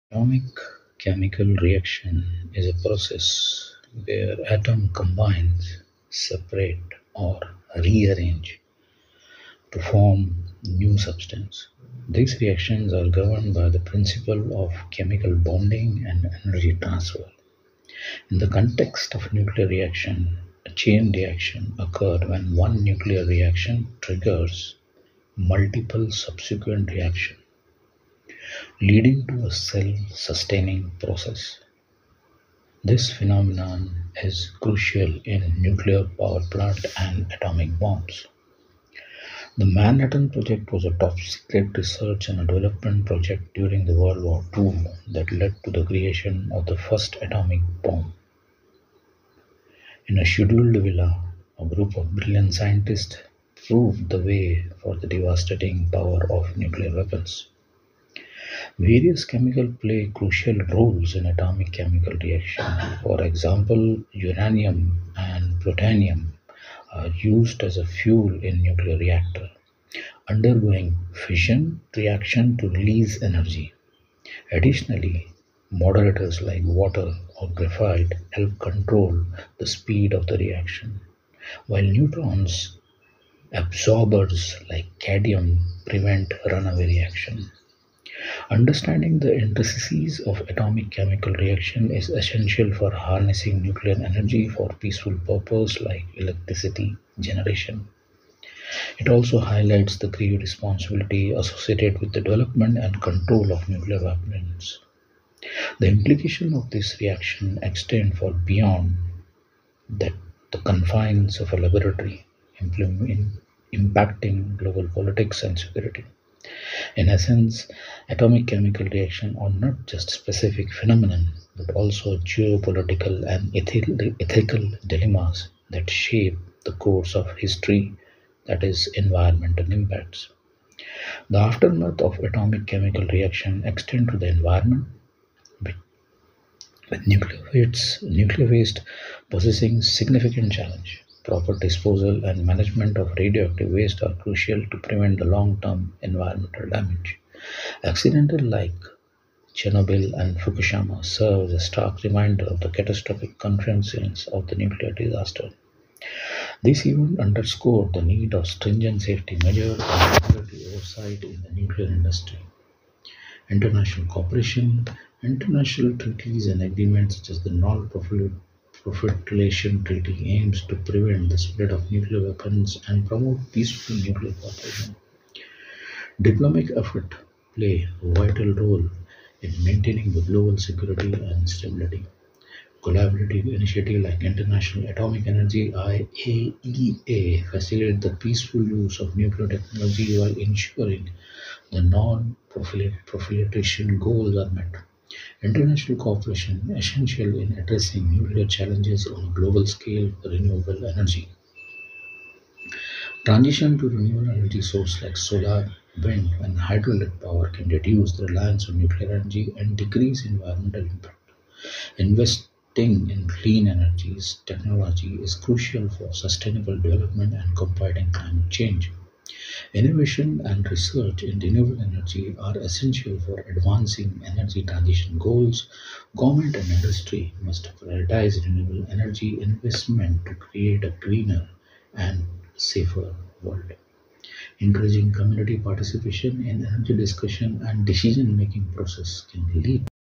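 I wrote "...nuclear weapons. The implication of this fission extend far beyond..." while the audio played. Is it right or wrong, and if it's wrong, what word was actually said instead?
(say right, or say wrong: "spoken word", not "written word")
wrong: "reaction", not "fission".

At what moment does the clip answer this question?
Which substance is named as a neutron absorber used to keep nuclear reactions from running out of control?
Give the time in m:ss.
1:24.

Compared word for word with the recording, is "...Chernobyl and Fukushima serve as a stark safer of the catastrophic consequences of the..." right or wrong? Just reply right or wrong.
wrong.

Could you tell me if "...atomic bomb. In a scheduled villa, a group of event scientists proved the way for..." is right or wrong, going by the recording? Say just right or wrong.
wrong.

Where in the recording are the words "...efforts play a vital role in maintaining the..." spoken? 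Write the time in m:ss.
2:56.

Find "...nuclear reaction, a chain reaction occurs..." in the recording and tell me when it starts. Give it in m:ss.
0:19.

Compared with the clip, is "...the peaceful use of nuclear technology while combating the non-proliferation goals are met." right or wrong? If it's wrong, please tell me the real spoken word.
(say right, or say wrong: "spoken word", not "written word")
wrong: "ensuring", not "combating".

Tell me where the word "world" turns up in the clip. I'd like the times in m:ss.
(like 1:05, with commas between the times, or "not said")
0:43, 3:53.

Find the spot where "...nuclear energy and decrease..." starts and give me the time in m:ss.
3:28.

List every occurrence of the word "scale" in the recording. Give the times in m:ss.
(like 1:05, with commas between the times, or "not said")
3:19.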